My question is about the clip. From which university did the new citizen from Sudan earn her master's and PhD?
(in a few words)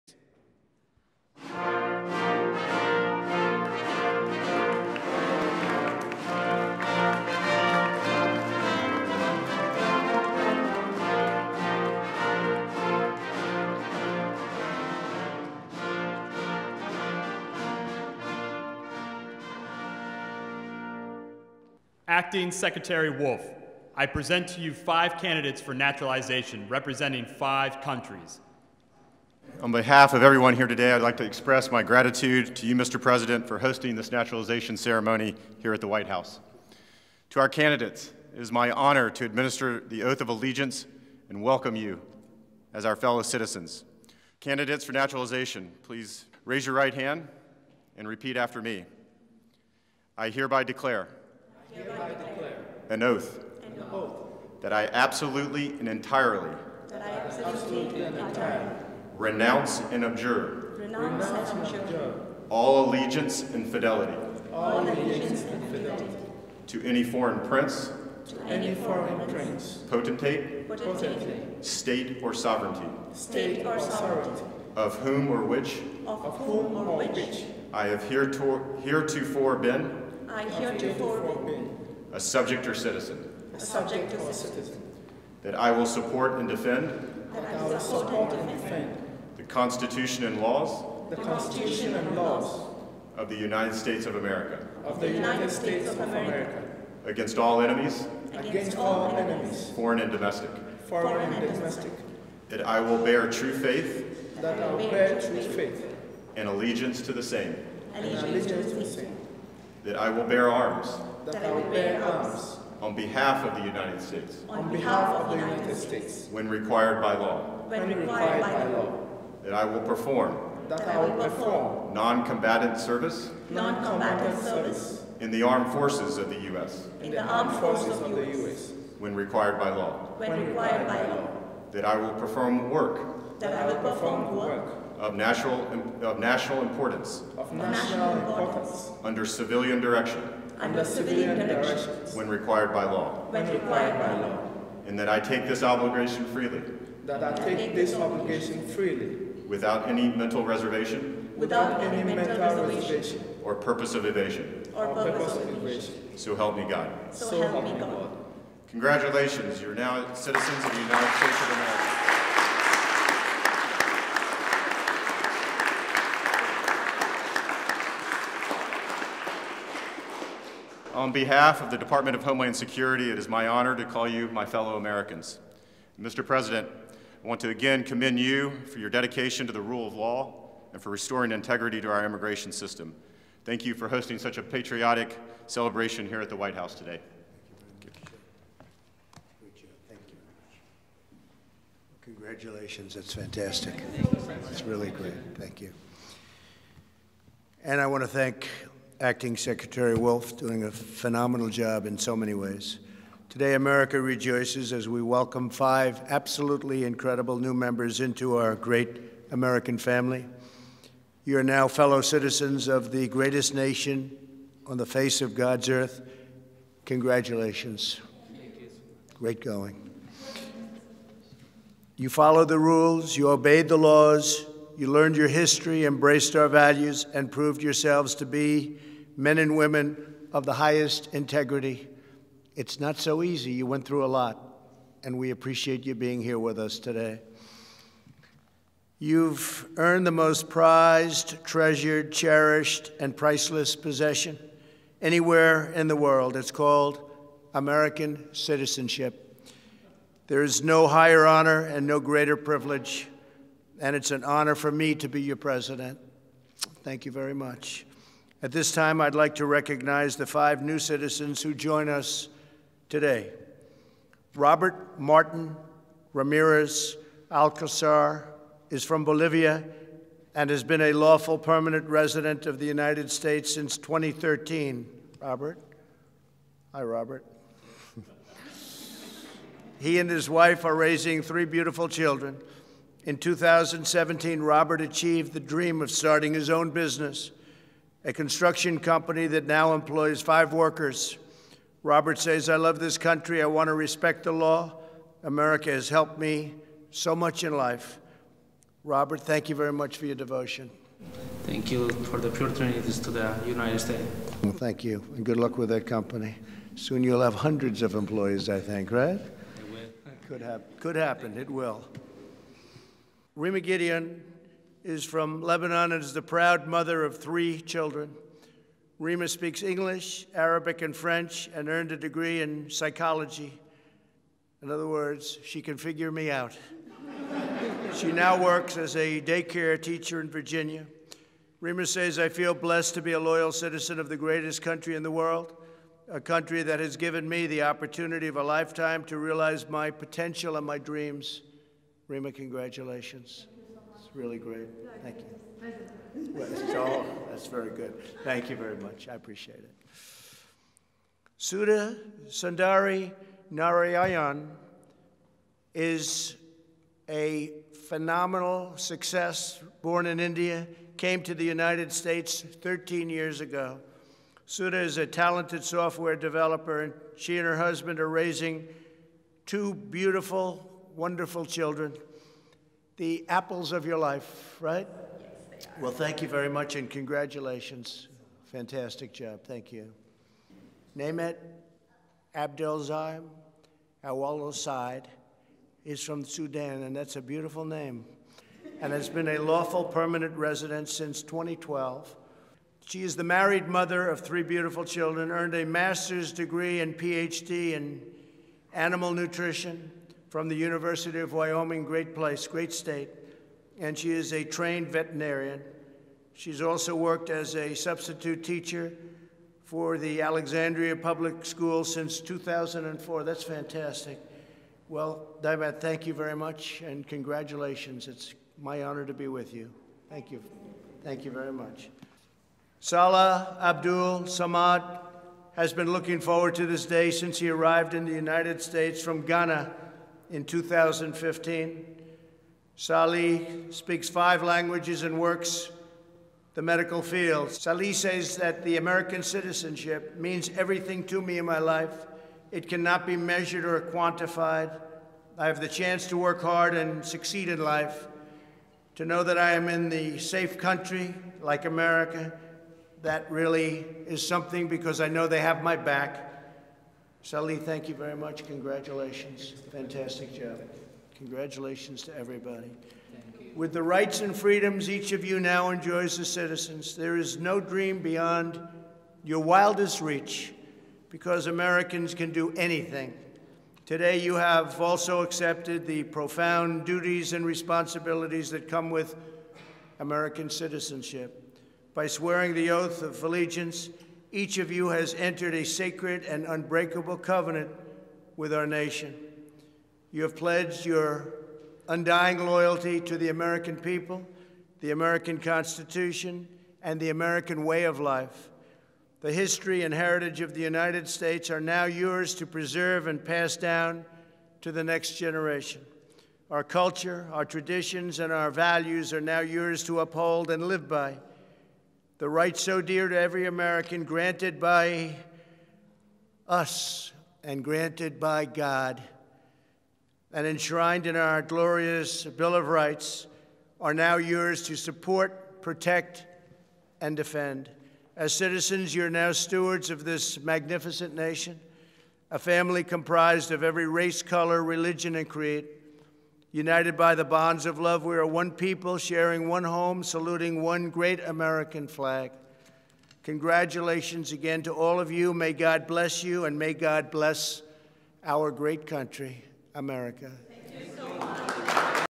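University of Wyoming.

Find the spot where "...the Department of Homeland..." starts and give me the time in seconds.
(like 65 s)
171 s.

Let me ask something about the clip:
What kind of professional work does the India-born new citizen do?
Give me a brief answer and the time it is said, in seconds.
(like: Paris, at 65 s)
Software developer, at 365 s.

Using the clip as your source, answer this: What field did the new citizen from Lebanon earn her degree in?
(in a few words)
Psychology.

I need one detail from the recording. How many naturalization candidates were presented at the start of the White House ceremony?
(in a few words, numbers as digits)
5.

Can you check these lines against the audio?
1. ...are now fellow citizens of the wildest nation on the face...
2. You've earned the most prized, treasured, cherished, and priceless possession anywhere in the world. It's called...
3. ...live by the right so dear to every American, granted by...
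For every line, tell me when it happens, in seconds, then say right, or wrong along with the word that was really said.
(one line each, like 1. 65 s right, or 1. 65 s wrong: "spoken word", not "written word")
1. 211 s wrong: "greatest", not "wildest"
2. 238 s right
3. 510 s right.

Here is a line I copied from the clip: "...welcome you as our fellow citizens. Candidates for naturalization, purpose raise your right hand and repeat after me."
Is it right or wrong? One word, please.
wrong.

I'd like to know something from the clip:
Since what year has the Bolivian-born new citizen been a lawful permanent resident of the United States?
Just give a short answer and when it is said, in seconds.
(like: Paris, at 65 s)
2013, at 273 s.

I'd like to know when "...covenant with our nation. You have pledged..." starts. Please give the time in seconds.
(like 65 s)
487 s.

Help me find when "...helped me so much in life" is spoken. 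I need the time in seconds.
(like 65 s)
295 s.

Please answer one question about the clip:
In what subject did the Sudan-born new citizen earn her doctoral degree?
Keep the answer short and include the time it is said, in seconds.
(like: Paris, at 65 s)
Animal nutrition, at 398 s.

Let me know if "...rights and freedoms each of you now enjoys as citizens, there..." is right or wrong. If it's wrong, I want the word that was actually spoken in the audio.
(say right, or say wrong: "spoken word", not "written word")
right.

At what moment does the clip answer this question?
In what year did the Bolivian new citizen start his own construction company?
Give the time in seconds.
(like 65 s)
283 s.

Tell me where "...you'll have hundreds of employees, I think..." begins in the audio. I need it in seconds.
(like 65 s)
307 s.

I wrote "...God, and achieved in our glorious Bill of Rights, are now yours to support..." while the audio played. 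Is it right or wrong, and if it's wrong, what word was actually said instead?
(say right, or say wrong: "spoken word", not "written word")
wrong: "enshrined", not "achieved".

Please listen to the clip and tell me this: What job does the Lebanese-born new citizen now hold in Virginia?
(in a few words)
Daycare teacher.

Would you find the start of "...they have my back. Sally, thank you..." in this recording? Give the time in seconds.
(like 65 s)
455 s.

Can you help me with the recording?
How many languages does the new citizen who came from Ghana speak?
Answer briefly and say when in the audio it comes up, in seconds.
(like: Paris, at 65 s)
5, at 434 s.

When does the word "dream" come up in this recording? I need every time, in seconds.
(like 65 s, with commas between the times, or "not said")
285 s, 340 s, 467 s.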